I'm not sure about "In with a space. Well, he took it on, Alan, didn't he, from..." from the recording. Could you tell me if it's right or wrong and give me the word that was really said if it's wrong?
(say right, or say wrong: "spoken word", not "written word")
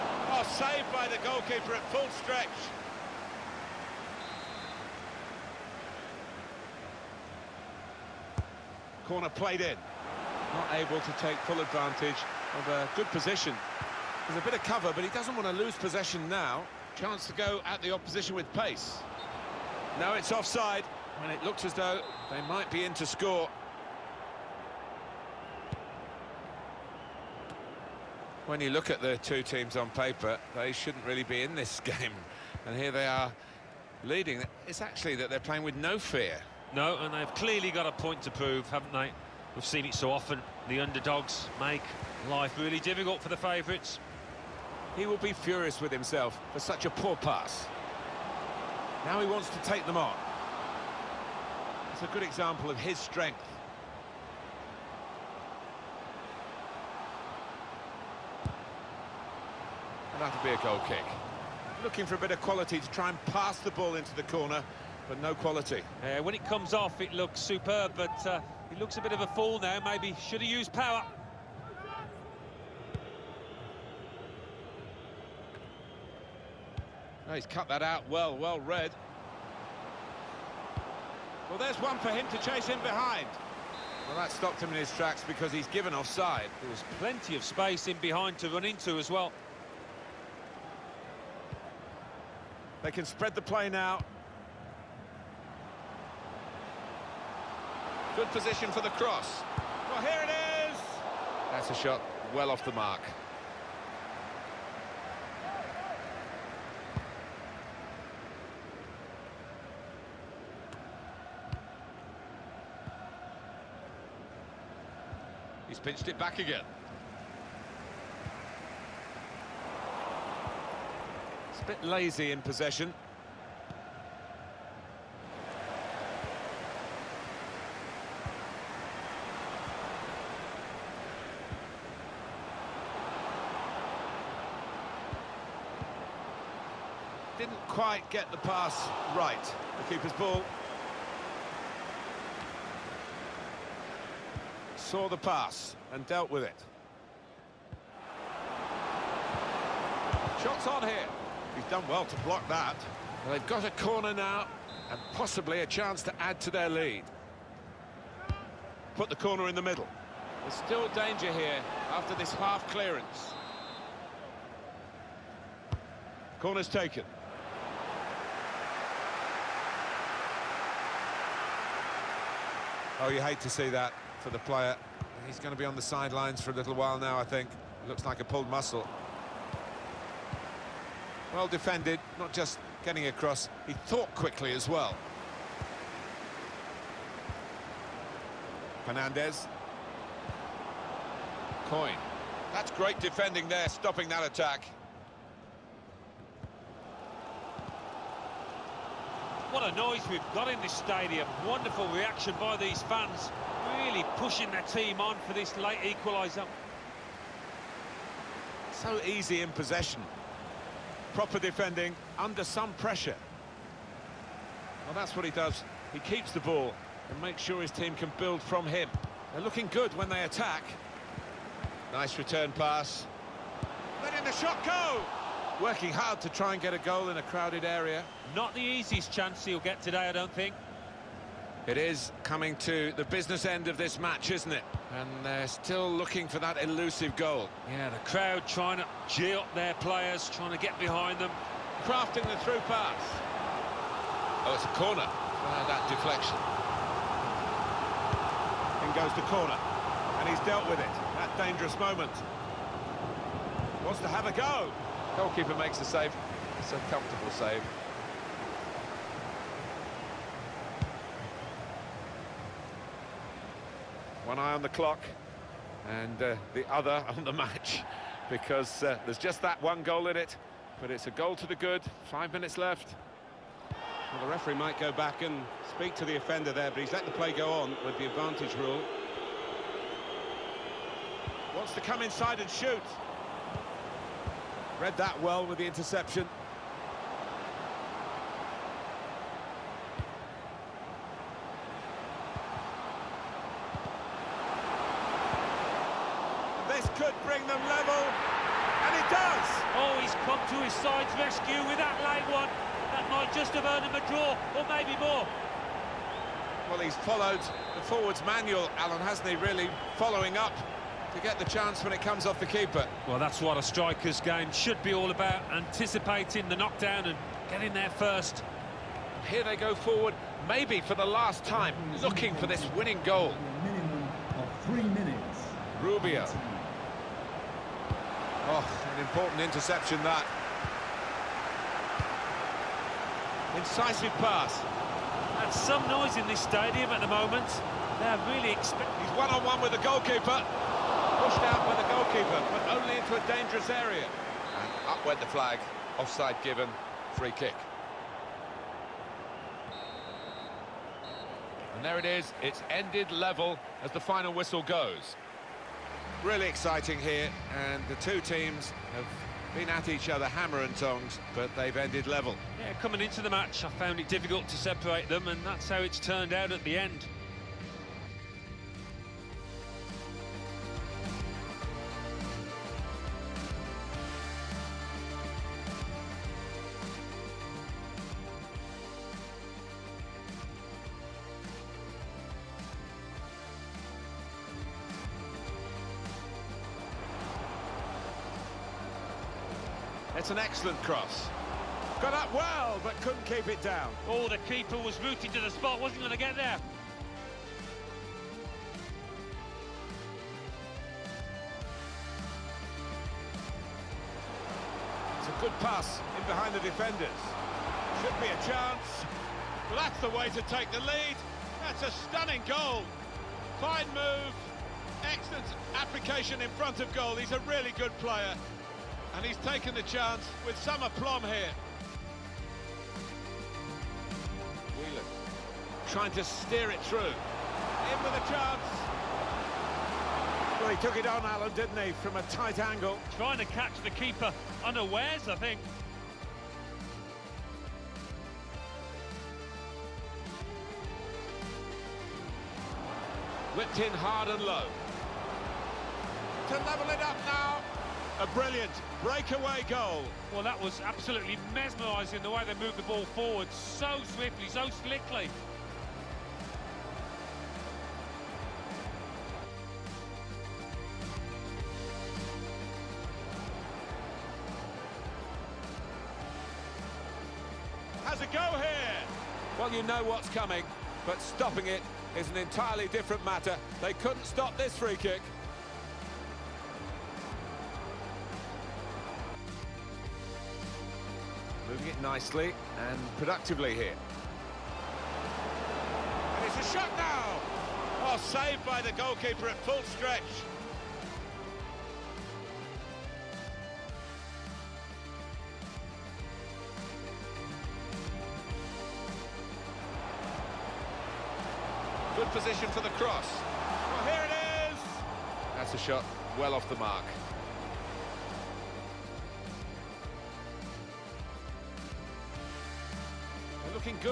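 wrong: "chance", not "space".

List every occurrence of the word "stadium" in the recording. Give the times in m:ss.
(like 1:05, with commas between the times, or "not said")
3:20, 5:36.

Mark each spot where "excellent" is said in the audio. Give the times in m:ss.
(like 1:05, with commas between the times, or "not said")
6:30, 6:55.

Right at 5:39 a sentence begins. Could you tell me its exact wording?
He's one-on-one -on -one with the goalkeeper.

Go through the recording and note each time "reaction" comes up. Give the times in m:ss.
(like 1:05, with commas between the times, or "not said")
3:21.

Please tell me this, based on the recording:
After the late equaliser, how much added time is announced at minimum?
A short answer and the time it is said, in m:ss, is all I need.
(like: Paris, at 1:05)
3 minutes, at 5:24.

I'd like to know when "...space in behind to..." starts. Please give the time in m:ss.
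1:27.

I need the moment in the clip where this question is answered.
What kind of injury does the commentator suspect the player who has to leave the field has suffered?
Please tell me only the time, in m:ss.
2:58.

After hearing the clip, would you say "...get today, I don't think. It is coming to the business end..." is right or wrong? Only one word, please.
right.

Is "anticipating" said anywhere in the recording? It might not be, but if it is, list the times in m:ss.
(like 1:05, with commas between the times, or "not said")
5:15.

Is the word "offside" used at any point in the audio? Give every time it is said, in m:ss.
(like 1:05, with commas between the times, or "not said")
0:20, 1:25, 5:45.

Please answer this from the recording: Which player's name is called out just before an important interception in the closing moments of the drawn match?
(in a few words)
Rubio.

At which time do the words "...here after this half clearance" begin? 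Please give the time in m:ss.
2:41.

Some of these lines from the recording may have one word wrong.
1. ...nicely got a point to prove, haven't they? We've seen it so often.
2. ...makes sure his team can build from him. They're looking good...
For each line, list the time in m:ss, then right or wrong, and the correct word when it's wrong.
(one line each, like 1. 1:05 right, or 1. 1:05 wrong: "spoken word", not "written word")
1. 0:37 wrong: "clearly", not "nicely"
2. 3:37 right.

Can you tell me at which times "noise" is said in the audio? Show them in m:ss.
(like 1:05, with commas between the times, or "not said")
3:19, 5:35.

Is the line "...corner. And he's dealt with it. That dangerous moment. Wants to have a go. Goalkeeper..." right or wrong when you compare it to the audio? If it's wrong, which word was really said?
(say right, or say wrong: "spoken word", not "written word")
right.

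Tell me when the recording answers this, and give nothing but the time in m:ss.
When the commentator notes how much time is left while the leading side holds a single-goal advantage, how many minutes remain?
4:32.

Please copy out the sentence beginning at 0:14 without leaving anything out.
There's a bit of cover, but he doesn't want to lose possession now.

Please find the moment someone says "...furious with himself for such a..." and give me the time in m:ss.
0:45.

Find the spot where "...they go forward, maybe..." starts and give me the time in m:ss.
5:19.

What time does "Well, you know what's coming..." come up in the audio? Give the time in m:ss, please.
7:49.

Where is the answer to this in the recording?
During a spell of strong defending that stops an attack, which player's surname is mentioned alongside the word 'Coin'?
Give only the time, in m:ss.
3:08.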